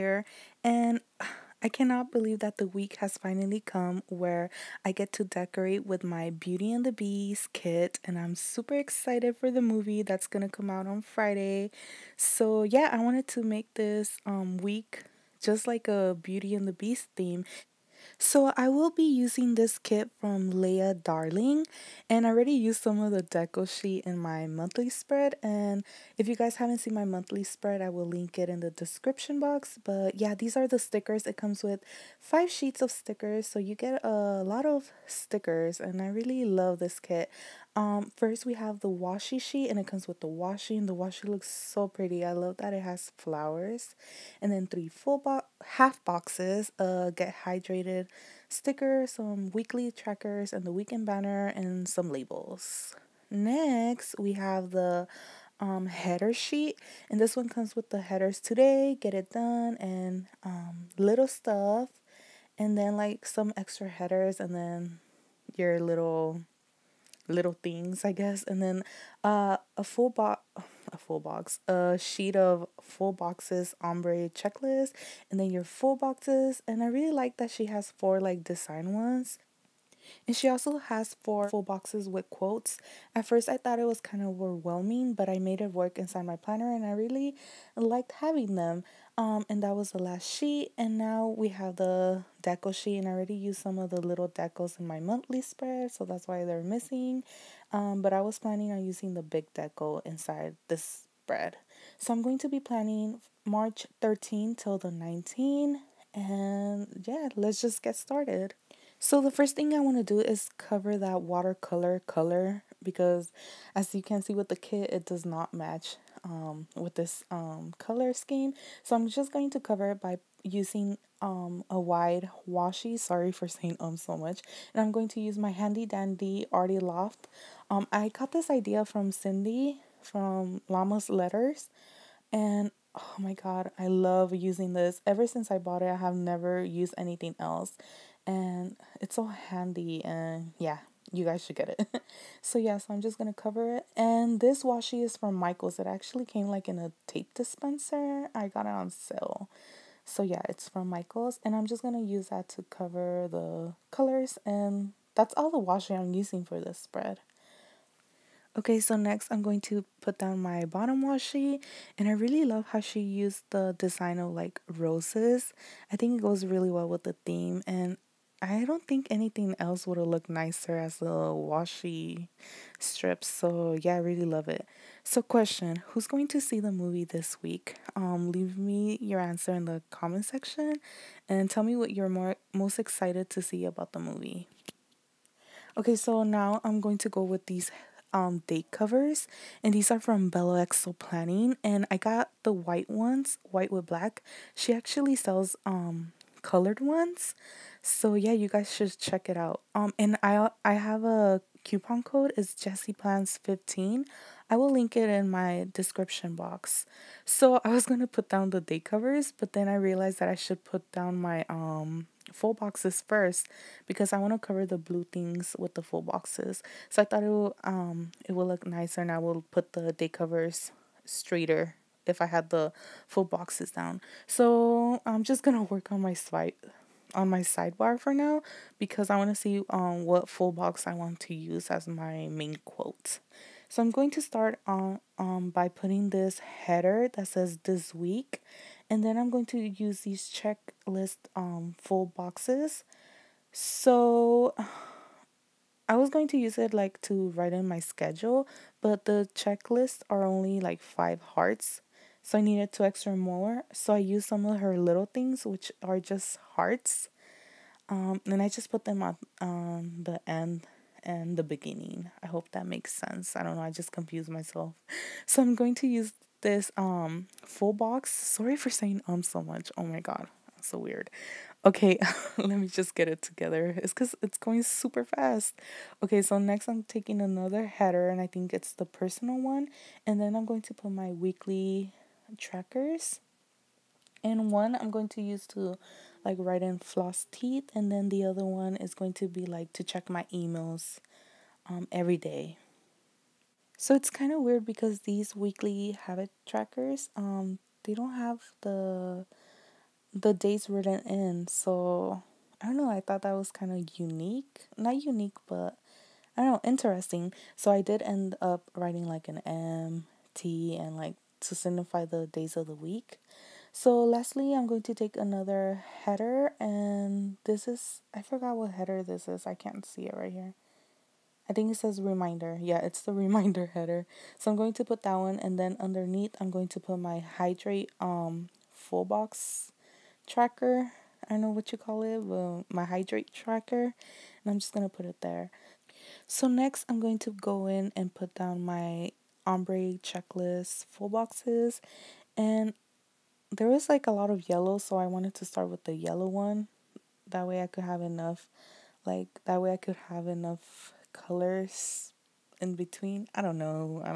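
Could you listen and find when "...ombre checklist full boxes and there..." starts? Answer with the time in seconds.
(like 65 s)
339 s.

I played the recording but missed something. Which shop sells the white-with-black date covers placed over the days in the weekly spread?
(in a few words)
BelloXO Planning.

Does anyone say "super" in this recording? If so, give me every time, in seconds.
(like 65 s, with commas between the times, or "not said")
8 s, 274 s.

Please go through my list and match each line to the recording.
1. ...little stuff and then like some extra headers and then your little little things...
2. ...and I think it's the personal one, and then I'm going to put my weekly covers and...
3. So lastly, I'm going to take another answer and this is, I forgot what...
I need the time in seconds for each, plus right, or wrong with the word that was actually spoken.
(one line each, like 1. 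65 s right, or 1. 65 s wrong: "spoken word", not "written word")
1. 60 s right
2. 278 s wrong: "trackers", not "covers"
3. 313 s wrong: "header", not "answer".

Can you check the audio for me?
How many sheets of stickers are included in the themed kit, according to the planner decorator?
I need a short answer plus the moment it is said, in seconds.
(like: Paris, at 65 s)
5, at 32 s.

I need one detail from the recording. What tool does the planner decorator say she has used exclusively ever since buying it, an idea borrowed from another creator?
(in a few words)
Artie Loft.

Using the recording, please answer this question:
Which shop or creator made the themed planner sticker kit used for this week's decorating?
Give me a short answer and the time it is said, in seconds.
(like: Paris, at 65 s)
Leigha Darling, at 20 s.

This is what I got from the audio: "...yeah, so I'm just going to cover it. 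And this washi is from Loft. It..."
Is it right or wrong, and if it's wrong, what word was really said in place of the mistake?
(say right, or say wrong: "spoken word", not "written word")
wrong: "Michaels", not "Loft".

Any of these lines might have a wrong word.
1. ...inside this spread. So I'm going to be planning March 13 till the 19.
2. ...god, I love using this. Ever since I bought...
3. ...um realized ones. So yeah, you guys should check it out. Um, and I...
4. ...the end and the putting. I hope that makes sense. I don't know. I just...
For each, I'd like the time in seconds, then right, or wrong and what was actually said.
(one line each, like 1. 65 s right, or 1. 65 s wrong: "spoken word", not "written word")
1. 100 s right
2. 133 s right
3. 195 s wrong: "colored", not "realized"
4. 260 s wrong: "beginning", not "putting".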